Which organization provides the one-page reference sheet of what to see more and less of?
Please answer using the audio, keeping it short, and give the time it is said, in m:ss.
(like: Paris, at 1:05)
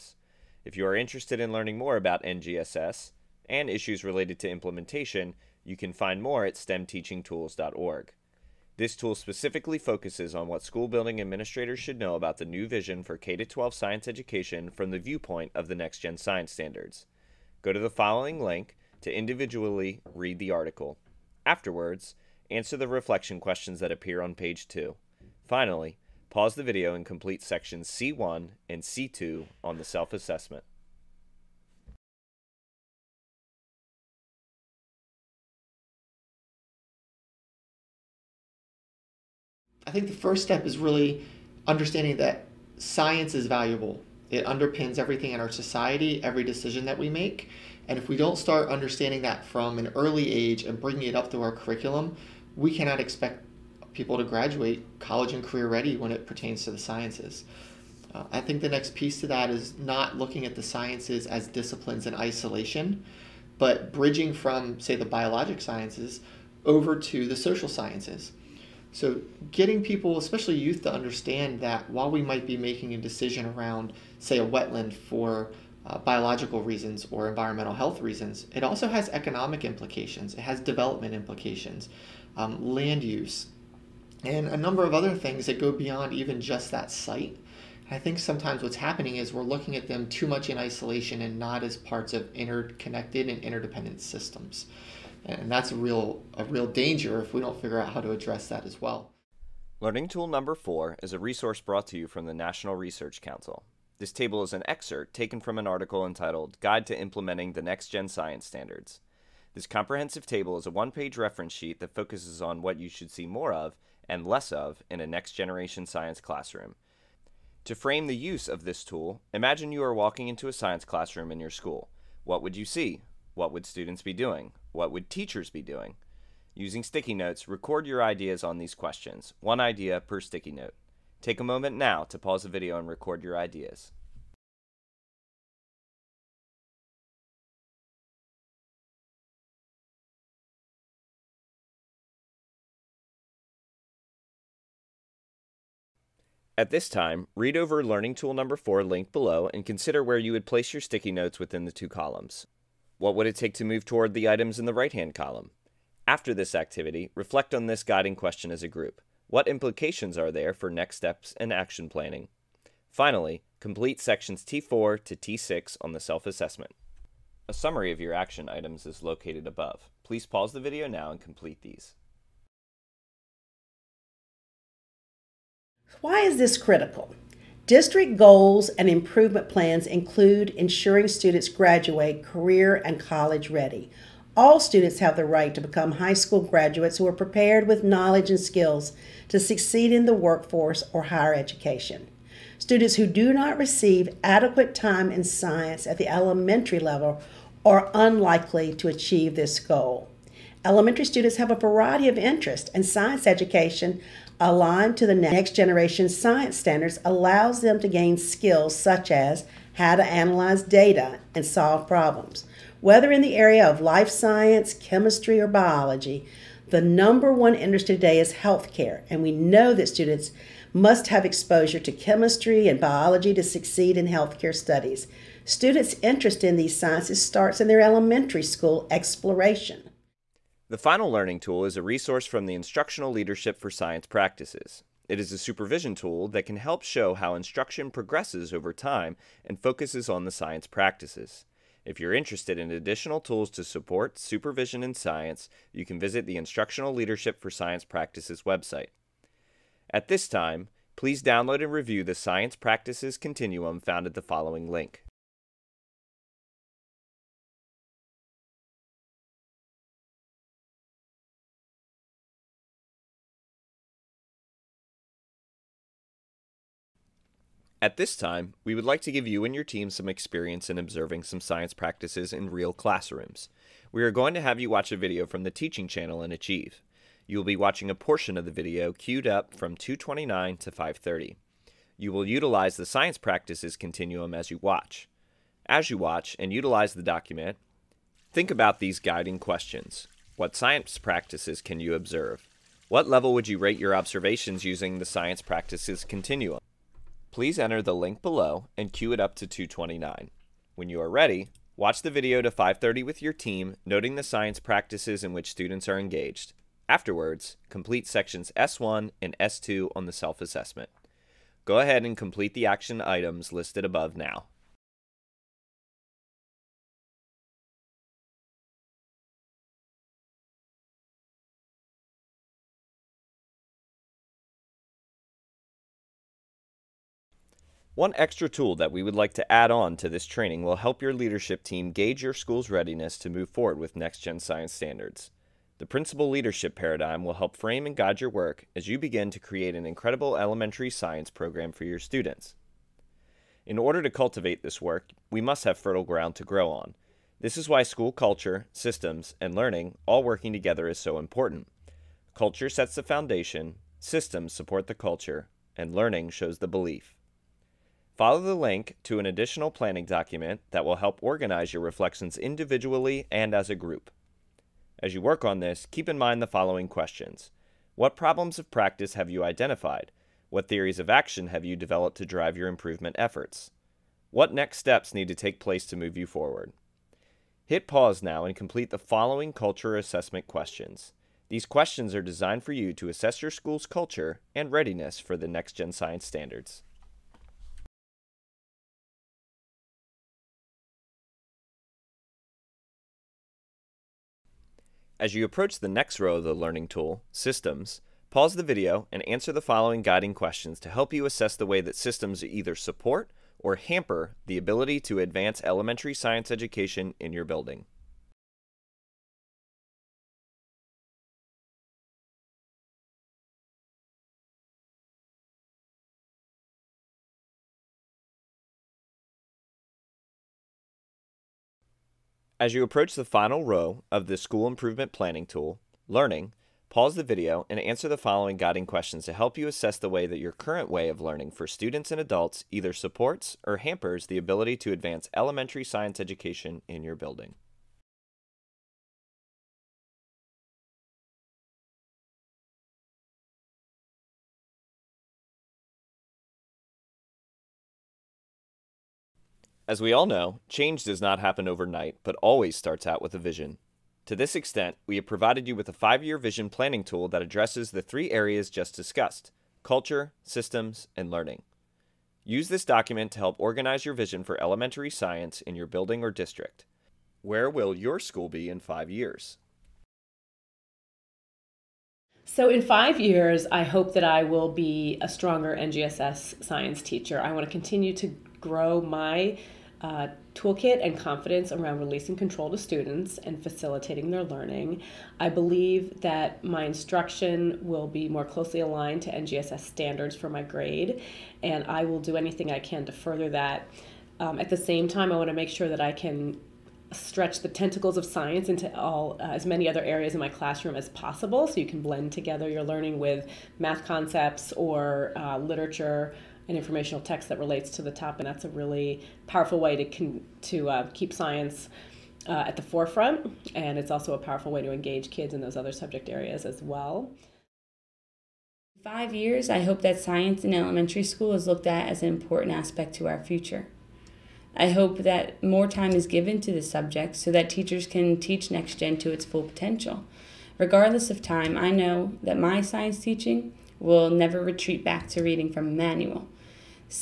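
National Research Council, at 1:42.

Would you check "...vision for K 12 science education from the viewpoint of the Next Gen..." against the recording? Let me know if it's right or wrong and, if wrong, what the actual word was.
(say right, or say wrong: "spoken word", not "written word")
right.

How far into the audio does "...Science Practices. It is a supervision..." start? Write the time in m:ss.
3:53.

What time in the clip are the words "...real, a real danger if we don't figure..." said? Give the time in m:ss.
1:35.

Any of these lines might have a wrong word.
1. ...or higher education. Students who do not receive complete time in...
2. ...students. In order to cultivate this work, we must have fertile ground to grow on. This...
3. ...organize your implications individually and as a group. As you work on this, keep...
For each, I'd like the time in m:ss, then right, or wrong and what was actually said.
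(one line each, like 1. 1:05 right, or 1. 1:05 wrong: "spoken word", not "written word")
1. 3:10 wrong: "adequate", not "complete"
2. 5:41 right
3. 6:01 wrong: "reflections", not "implications".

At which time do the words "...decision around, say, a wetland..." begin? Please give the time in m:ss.
1:12.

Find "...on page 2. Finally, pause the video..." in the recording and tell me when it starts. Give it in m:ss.
0:24.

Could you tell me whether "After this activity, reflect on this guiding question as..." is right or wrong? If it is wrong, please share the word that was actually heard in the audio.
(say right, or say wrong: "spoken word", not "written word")
right.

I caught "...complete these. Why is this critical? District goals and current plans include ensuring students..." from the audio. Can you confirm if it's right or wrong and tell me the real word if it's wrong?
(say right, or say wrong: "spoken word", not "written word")
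wrong: "improvement", not "current".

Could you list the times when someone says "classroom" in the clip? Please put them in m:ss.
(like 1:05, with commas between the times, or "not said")
1:56, 2:00, 4:32, 8:20.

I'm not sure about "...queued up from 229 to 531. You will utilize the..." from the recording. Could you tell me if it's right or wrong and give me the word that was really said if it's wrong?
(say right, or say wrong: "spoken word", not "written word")
wrong: "530", not "531".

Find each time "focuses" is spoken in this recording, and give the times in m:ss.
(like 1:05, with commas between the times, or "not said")
0:09, 1:51, 3:59.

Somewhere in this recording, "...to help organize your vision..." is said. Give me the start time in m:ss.
7:43.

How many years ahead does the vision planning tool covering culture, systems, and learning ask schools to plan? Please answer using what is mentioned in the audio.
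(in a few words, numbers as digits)
5.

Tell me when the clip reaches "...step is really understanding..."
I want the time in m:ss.
0:40.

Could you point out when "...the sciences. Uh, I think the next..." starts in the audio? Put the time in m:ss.
0:56.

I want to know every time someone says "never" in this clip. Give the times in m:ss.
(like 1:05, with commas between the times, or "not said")
8:54.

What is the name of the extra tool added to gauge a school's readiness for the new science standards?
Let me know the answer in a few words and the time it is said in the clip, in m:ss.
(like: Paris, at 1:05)
principal leadership paradigm, at 5:35.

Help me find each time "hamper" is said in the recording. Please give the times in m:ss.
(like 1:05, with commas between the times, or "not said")
6:43, 7:13.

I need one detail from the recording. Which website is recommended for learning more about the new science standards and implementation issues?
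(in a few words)
stemteachingtools.org.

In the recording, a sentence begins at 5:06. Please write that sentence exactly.
Afterwards, complete sections S1 and S2 on the self-assessment.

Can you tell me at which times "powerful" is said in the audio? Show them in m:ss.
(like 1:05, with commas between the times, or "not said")
8:29, 8:34.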